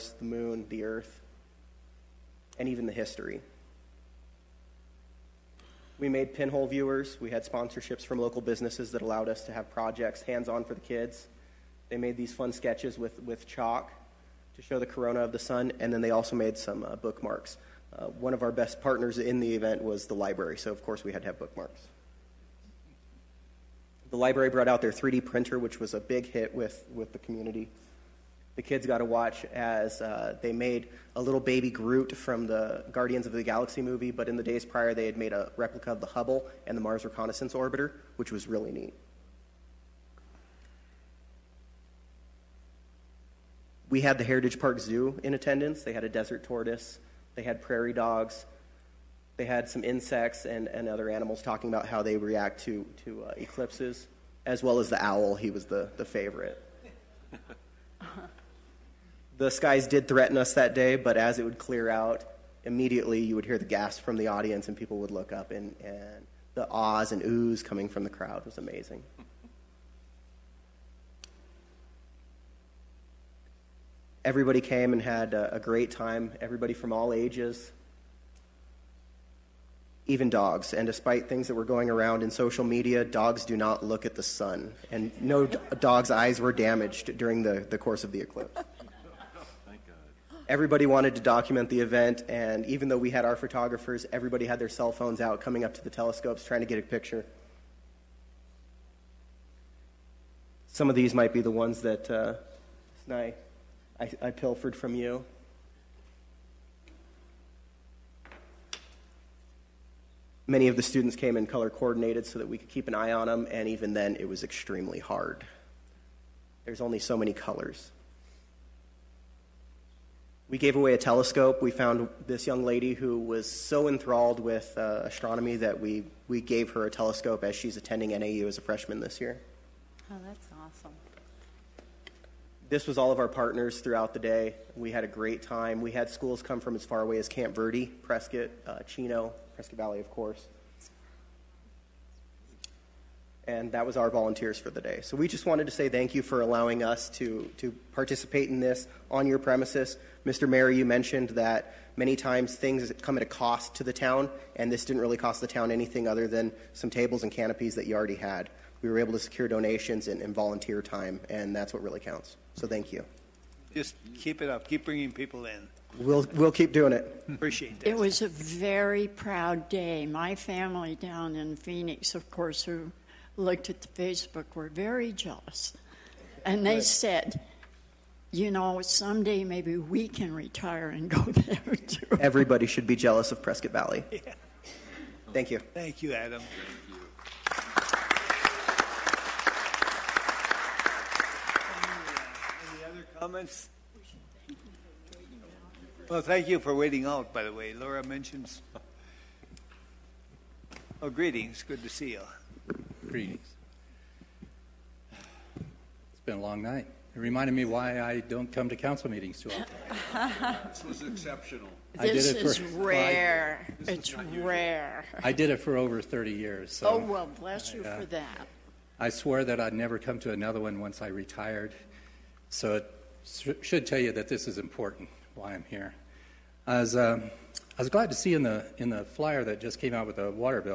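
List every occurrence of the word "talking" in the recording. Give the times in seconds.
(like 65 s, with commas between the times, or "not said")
51 s.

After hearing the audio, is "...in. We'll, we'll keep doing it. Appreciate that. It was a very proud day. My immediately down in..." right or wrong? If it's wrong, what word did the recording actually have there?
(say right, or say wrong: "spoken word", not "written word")
wrong: "family", not "immediately".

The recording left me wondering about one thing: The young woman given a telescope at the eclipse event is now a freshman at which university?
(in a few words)
NAU.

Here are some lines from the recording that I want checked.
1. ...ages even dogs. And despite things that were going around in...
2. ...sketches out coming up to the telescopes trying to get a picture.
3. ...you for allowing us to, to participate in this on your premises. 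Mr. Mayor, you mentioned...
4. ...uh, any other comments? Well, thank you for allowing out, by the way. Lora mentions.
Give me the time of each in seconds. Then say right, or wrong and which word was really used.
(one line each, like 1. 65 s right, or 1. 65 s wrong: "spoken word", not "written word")
1. 77 s right
2. 94 s wrong: "phones", not "sketches"
3. 146 s right
4. 192 s wrong: "waiting", not "allowing".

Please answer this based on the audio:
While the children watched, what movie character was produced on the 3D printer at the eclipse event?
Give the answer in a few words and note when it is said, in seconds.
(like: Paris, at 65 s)
Baby Groot, at 31 s.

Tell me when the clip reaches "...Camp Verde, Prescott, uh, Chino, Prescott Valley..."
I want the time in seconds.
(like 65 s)
137 s.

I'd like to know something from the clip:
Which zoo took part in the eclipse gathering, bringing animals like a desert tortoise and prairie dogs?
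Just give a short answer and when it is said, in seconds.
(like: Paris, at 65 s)
Heritage Park Zoo, at 44 s.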